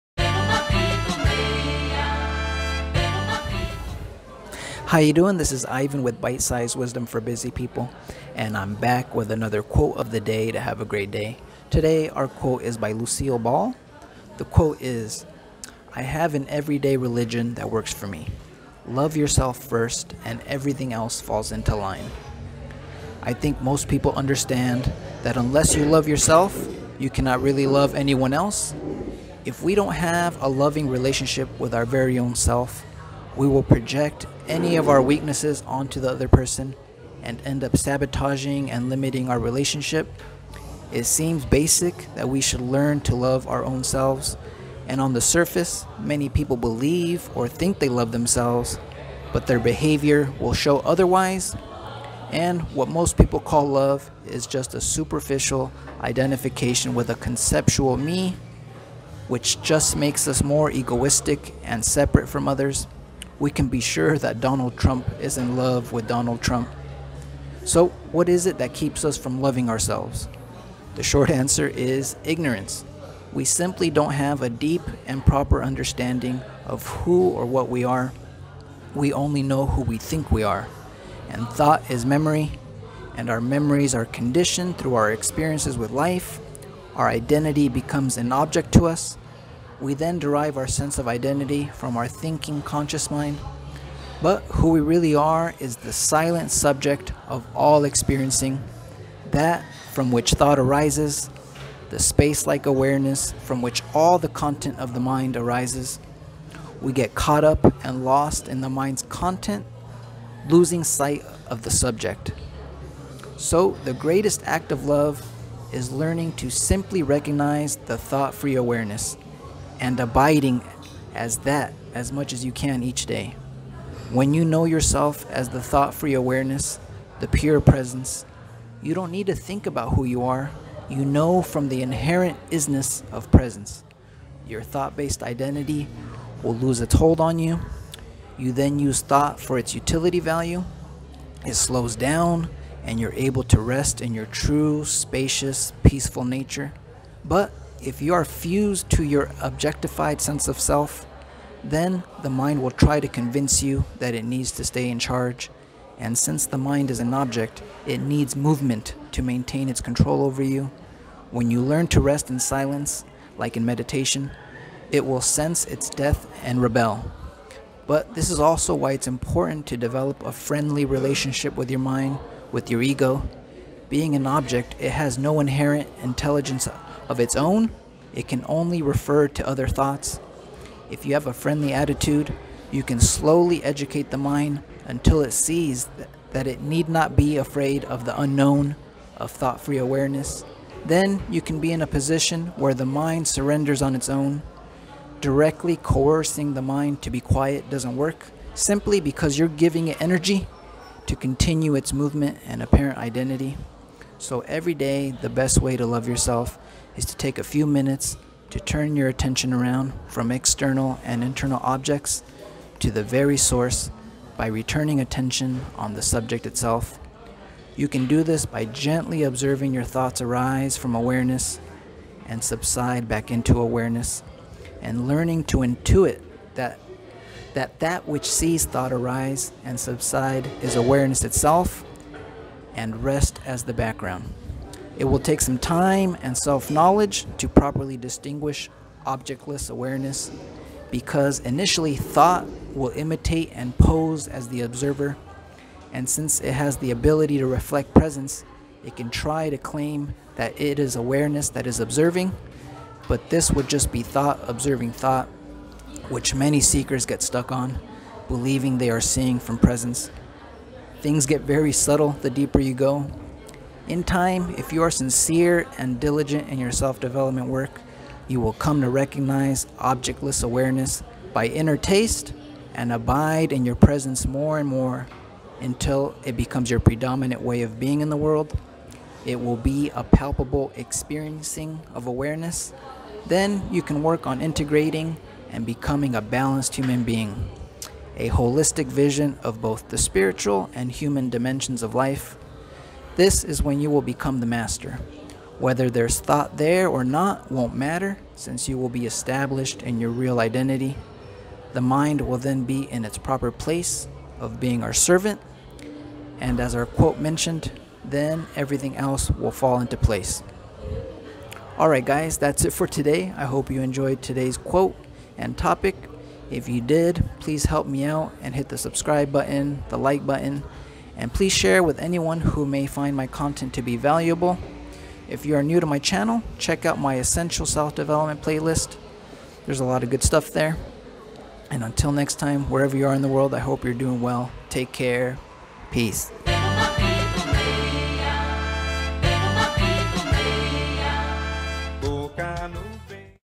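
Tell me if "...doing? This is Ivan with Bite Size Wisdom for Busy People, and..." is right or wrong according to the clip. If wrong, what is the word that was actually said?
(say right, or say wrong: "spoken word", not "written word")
right.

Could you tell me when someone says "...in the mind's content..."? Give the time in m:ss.
1:48.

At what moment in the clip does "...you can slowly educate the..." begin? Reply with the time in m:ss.
3:02.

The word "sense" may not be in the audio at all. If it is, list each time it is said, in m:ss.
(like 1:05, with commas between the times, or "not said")
1:30, 2:30, 2:45.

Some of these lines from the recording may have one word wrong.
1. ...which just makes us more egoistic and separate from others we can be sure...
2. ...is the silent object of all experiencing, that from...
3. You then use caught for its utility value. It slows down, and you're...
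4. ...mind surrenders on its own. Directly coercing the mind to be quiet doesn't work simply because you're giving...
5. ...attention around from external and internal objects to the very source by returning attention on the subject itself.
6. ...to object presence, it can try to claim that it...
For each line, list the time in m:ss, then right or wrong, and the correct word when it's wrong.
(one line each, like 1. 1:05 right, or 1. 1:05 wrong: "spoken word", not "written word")
1. 0:59 right
2. 1:35 wrong: "subject", not "object"
3. 2:18 wrong: "thought", not "caught"
4. 3:12 right
5. 3:29 right
6. 4:07 wrong: "reflect", not "object".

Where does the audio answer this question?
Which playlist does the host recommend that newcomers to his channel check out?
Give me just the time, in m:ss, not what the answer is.
5:27.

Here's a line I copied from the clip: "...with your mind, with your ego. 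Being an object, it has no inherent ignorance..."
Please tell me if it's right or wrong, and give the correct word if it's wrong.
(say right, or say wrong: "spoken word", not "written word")
wrong: "intelligence", not "ignorance".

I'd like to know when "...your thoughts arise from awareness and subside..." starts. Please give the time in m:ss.
3:39.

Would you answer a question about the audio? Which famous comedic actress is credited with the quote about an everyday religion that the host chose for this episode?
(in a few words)
Lucille Ball.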